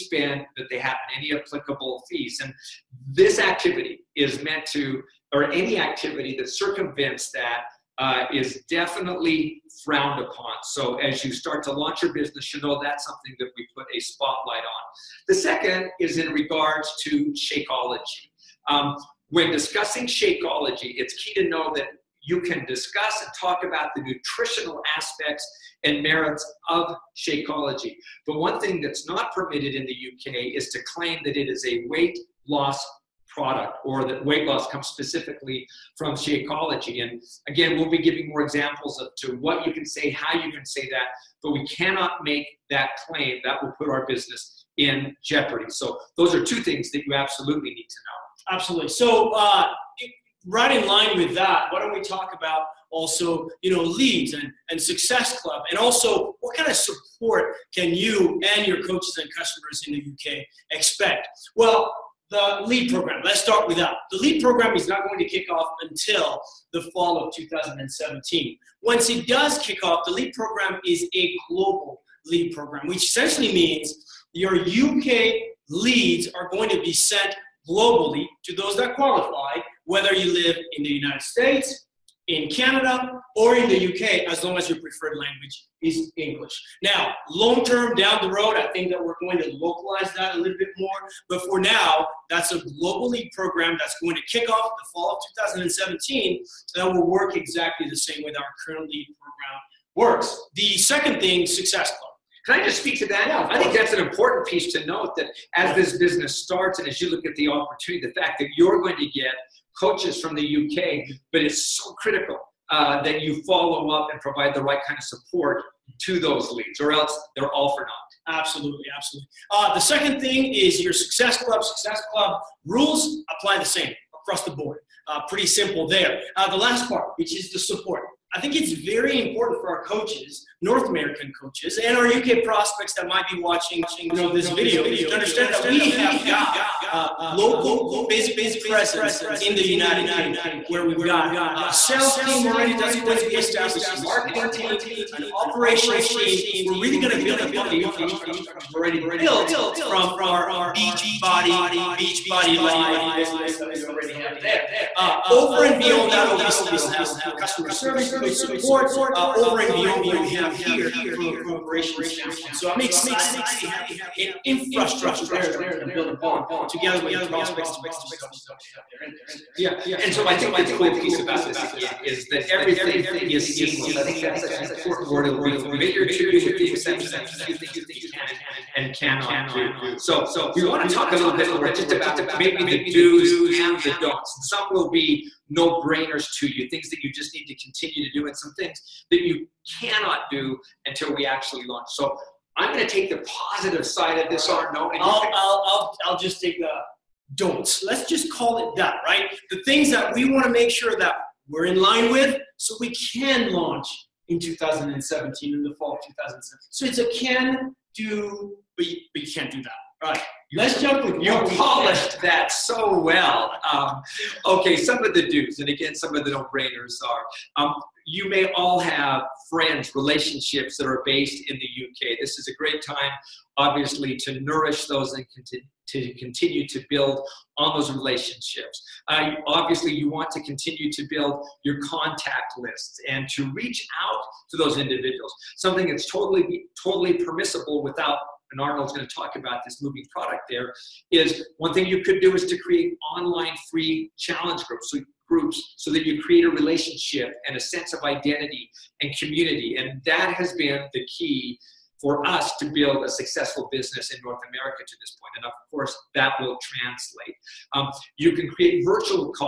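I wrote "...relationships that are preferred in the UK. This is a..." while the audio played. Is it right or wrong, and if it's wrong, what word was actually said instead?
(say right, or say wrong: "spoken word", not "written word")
wrong: "based", not "preferred".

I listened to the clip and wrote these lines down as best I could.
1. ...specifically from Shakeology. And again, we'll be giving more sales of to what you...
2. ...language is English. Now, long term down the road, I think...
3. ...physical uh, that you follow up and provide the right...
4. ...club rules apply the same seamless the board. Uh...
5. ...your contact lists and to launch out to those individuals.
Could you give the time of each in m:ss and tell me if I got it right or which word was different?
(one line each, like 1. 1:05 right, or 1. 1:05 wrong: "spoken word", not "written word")
1. 0:34 wrong: "examples", not "sales"
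2. 1:25 right
3. 1:51 wrong: "critical", not "physical"
4. 2:02 wrong: "across", not "seamless"
5. 3:51 wrong: "reach", not "launch".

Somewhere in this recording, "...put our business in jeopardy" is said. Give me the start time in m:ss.
0:43.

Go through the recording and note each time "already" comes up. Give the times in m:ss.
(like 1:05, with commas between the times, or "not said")
2:22, 2:28, 2:33.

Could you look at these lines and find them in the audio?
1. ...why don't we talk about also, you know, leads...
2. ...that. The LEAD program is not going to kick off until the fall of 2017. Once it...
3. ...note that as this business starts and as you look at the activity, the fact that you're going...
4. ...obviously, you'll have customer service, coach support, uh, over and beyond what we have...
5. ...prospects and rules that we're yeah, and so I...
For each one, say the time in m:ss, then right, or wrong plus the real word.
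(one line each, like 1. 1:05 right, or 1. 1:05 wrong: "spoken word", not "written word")
1. 0:51 right
2. 1:03 right
3. 1:44 wrong: "opportunity", not "activity"
4. 2:36 right
5. 2:47 wrong: "coaches", not "rules".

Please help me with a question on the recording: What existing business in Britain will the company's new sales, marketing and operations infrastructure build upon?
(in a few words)
Beachbody Live.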